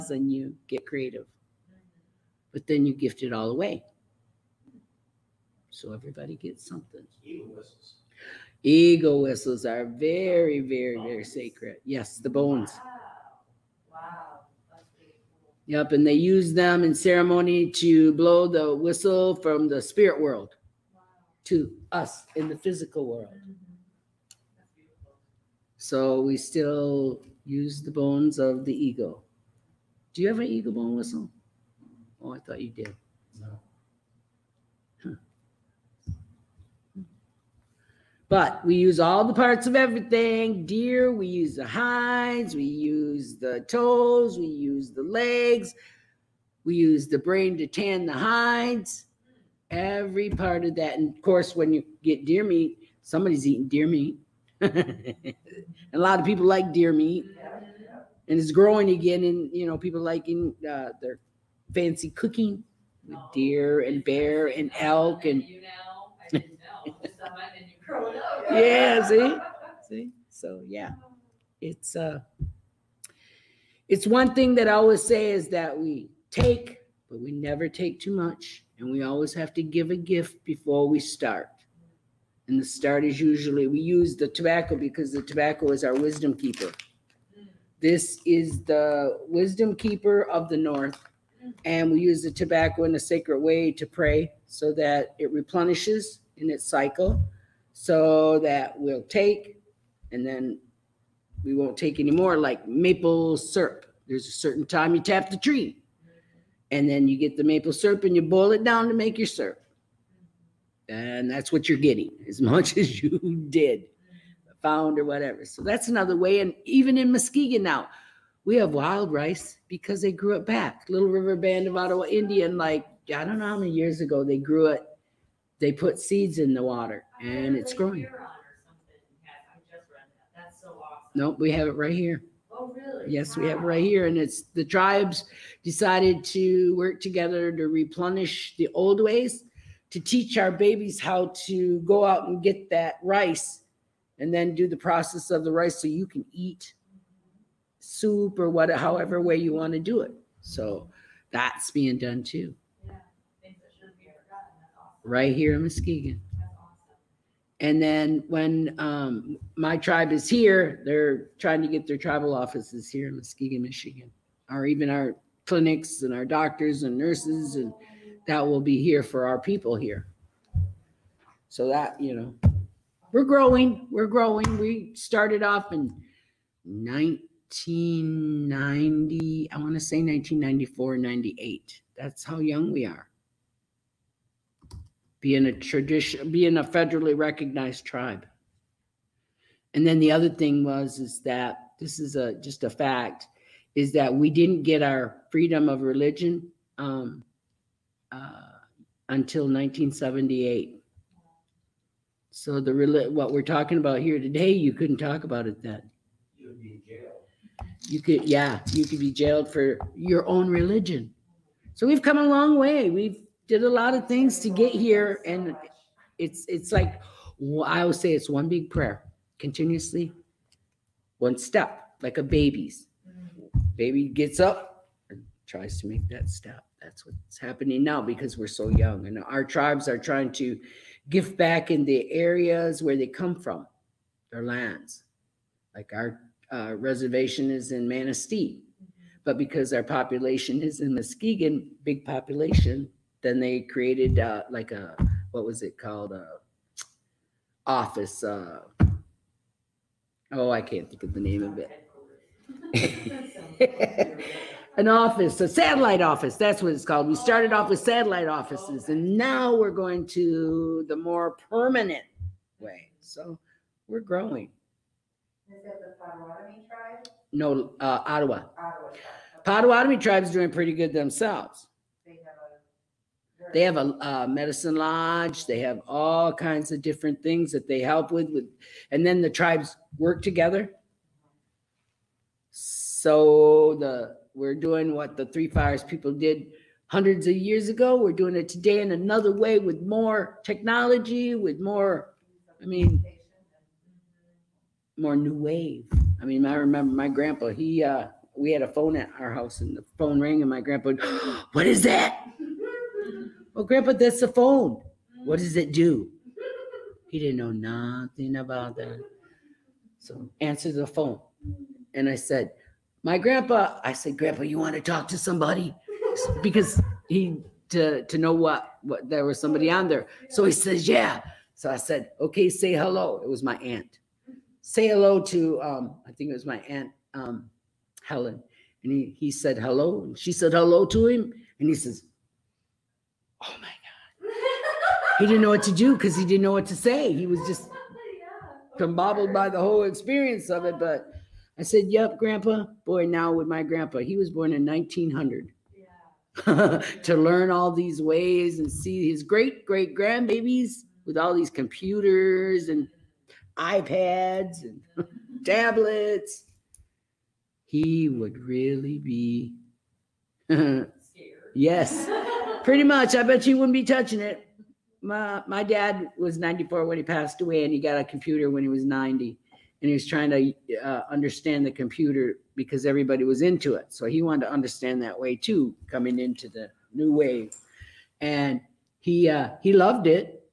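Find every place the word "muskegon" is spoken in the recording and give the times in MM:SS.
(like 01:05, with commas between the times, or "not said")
01:57, 02:35, 02:43, 04:00.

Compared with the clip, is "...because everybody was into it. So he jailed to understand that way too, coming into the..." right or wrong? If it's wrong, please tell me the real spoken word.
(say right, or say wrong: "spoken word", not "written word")
wrong: "wanted", not "jailed".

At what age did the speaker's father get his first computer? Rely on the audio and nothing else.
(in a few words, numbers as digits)
90.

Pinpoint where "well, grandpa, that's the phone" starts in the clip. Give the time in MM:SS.
05:03.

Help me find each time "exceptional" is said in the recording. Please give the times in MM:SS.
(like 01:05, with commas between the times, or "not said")
not said.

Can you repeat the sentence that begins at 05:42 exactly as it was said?
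Boy, now with my grandpa, he was born in 1900.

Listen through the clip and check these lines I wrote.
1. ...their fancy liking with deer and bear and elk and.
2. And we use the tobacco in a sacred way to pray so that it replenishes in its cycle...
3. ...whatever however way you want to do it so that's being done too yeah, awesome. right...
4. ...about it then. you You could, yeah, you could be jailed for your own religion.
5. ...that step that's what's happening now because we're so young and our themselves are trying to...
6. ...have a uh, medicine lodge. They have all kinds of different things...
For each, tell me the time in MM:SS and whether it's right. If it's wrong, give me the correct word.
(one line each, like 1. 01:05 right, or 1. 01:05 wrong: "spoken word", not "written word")
1. 01:01 wrong: "cooking", not "liking"
2. 01:31 right
3. 02:28 right
4. 03:25 right
5. 03:46 wrong: "tribes", not "themselves"
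6. 04:33 right.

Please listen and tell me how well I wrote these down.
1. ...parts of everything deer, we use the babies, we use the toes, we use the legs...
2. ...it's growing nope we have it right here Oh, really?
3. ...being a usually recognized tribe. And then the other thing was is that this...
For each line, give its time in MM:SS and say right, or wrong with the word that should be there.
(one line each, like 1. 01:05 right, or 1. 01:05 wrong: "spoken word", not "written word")
1. 00:39 wrong: "hides", not "babies"
2. 02:07 right
3. 03:06 wrong: "federally", not "usually".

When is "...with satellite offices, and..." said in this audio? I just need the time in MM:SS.
04:17.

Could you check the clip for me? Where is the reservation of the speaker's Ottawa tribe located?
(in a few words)
Manistee.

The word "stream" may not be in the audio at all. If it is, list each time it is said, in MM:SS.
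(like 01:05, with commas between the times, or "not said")
not said.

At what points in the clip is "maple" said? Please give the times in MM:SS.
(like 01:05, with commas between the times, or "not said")
01:42, 01:47.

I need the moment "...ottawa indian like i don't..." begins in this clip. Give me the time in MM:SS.
02:01.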